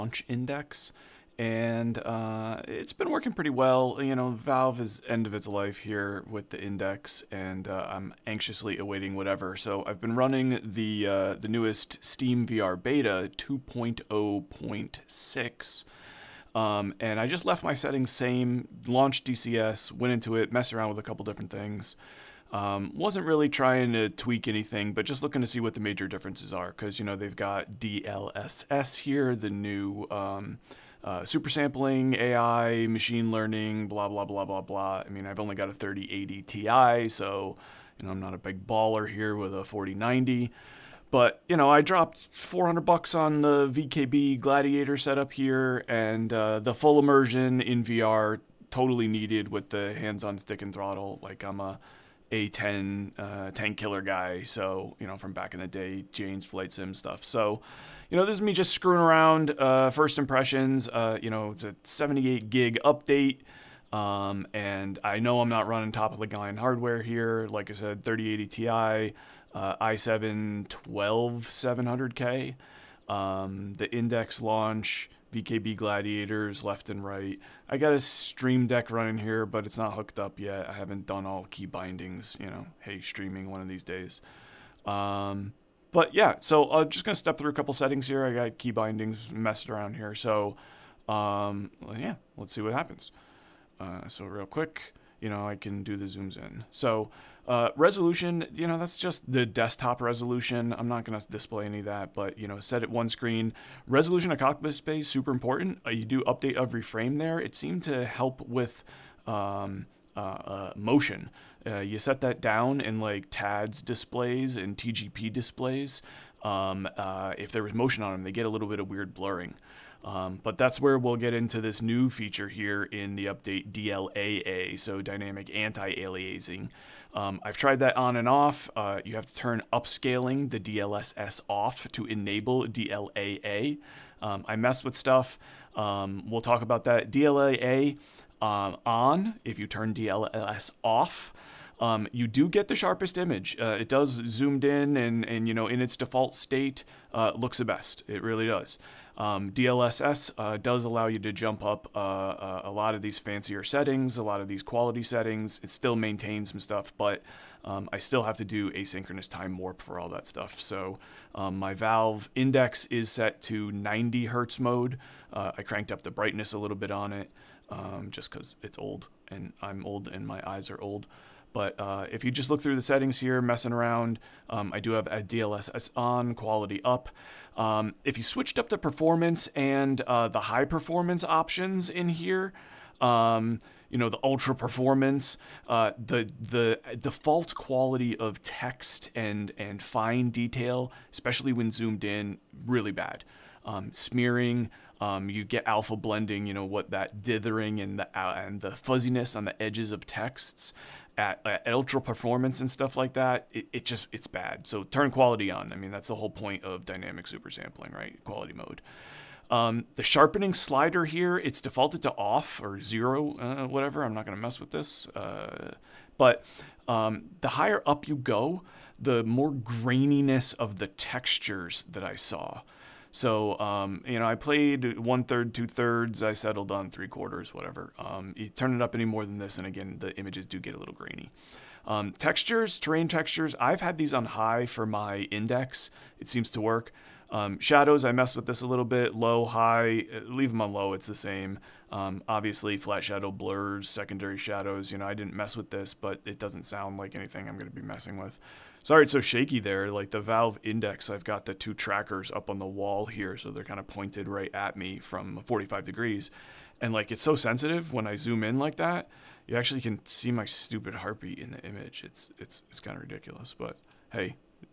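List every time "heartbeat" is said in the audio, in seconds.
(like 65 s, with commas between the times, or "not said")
260 s.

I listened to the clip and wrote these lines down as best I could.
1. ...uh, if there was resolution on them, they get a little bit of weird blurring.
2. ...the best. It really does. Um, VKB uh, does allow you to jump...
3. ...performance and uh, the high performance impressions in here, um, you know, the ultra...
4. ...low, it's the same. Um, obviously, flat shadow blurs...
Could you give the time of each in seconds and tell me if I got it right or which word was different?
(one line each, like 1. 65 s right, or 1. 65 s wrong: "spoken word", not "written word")
1. 116 s wrong: "motion", not "resolution"
2. 147 s wrong: "DLSS", not "VKB"
3. 178 s wrong: "options", not "impressions"
4. 240 s right.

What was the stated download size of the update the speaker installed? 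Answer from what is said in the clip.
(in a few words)
78 GB.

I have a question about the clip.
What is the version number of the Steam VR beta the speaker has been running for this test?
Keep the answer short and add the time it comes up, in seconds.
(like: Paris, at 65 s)
2.0.6, at 13 s.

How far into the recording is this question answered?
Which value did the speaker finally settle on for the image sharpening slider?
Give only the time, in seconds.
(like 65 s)
226 s.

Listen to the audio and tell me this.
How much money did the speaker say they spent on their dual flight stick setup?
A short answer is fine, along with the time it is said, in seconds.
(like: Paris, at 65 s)
$400, at 42 s.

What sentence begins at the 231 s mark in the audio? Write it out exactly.
Um, textures, terrain textures, I've had these on high for my index.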